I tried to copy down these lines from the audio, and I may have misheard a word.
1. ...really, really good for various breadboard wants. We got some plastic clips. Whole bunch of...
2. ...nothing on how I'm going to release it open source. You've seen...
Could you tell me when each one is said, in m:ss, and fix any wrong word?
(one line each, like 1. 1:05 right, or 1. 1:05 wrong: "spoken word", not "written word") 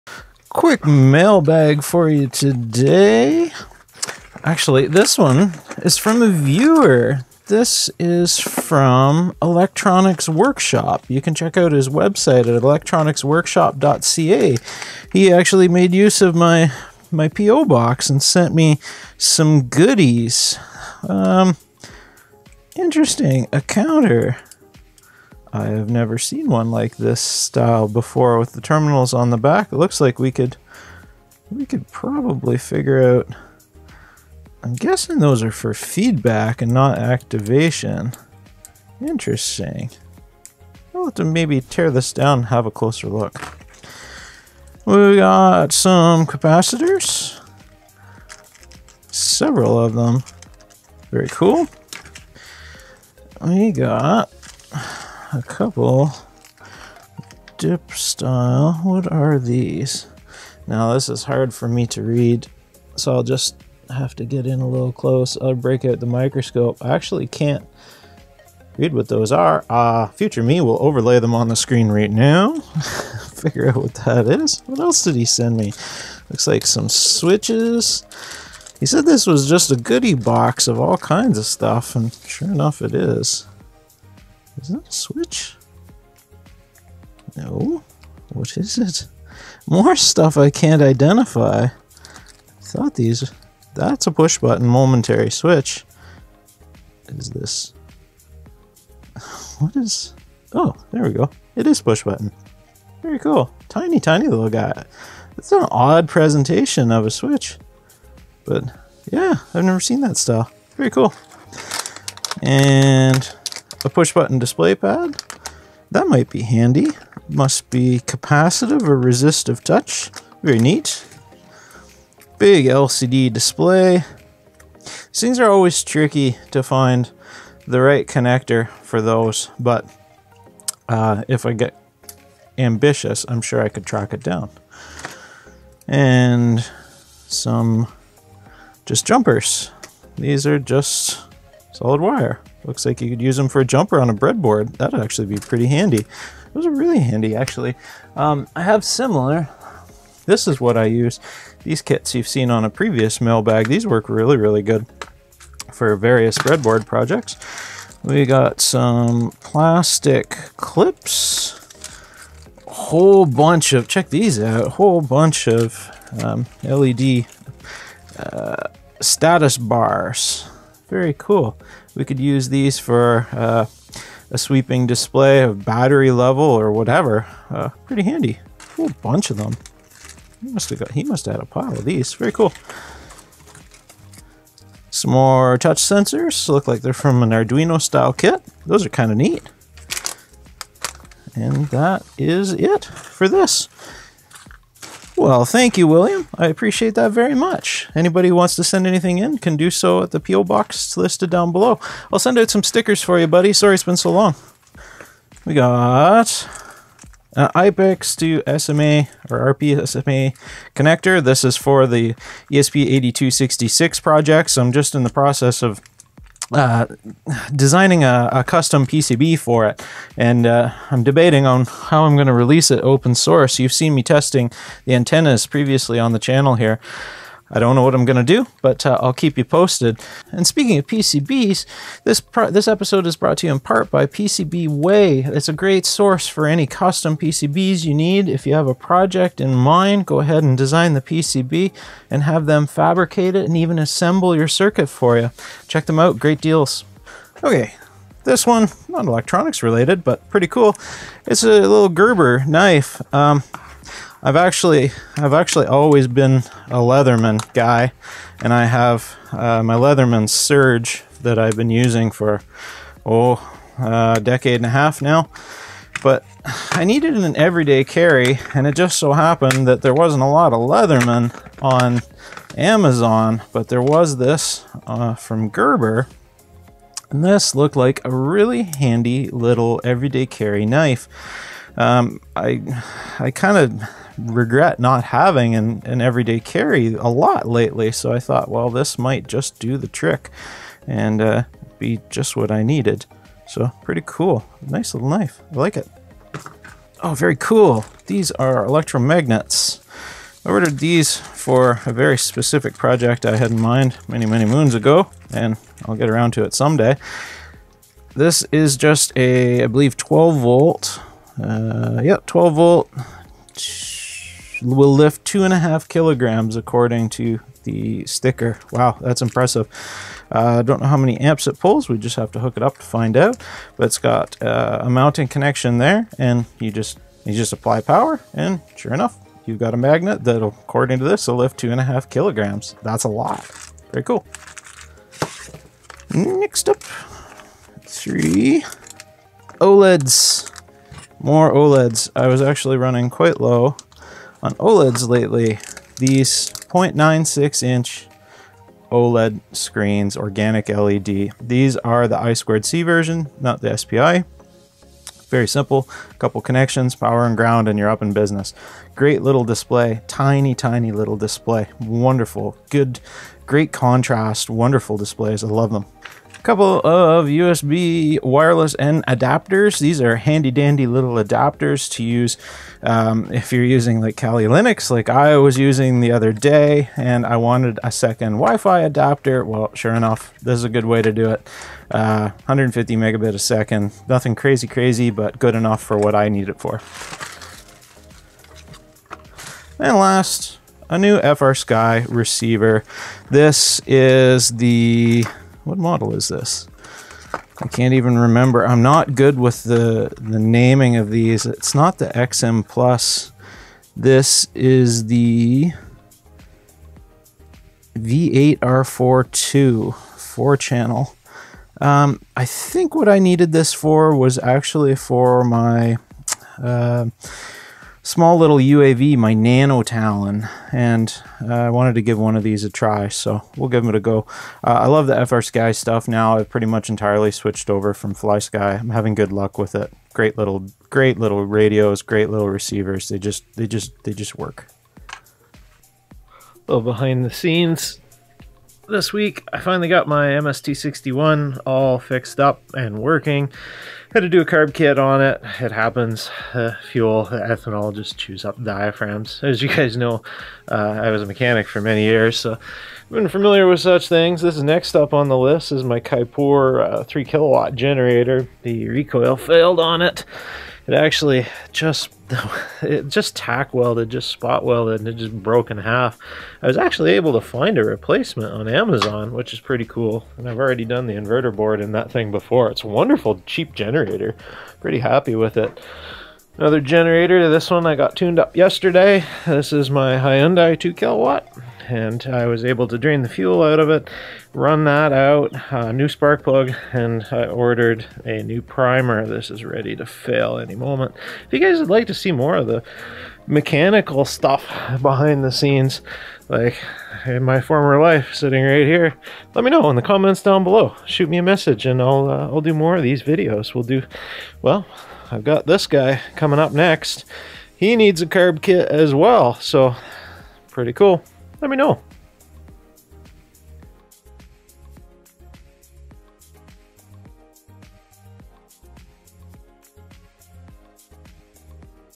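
1. 2:34 wrong: "projects", not "wants"
2. 3:41 wrong: "debating", not "nothing".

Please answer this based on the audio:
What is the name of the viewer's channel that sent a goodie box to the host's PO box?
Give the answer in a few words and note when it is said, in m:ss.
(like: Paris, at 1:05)
Electronics Workshop, at 0:09.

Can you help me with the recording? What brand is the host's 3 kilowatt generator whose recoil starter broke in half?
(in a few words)
Kipor.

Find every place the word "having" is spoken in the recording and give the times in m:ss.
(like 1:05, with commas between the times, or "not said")
4:45, 7:08.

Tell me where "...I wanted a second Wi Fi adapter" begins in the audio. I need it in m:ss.
6:17.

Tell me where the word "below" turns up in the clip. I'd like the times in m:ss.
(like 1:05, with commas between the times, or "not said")
3:21, 8:20.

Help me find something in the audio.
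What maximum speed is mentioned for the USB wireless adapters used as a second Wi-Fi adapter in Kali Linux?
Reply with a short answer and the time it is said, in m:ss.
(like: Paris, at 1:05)
150 megabit a second, at 6:22.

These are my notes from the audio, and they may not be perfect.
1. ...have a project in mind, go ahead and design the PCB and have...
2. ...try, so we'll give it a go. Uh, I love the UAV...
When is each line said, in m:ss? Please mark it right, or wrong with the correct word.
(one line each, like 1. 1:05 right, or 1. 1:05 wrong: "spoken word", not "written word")
1. 3:58 right
2. 7:02 wrong: "FrSky", not "UAV".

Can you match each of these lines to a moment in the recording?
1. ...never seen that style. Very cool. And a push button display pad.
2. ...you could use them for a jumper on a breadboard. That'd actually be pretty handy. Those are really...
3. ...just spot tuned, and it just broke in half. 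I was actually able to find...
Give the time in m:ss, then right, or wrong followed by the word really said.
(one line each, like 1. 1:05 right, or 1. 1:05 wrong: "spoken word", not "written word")
1. 1:49 right
2. 2:23 right
3. 7:44 wrong: "welded", not "tuned".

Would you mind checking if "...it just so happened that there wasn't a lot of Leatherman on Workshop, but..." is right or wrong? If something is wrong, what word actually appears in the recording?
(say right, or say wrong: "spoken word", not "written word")
wrong: "Amazon", not "Workshop".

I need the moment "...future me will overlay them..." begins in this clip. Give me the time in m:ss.
1:10.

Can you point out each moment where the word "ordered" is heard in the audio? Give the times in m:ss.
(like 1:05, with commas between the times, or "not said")
5:00, 8:07.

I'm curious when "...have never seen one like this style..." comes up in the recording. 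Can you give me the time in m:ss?
0:25.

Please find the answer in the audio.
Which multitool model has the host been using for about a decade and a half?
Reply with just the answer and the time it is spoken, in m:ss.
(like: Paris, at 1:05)
Leatherman Surge, at 4:19.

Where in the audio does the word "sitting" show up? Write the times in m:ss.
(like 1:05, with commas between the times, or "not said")
8:18.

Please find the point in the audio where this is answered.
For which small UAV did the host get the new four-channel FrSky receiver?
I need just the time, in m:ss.
6:59.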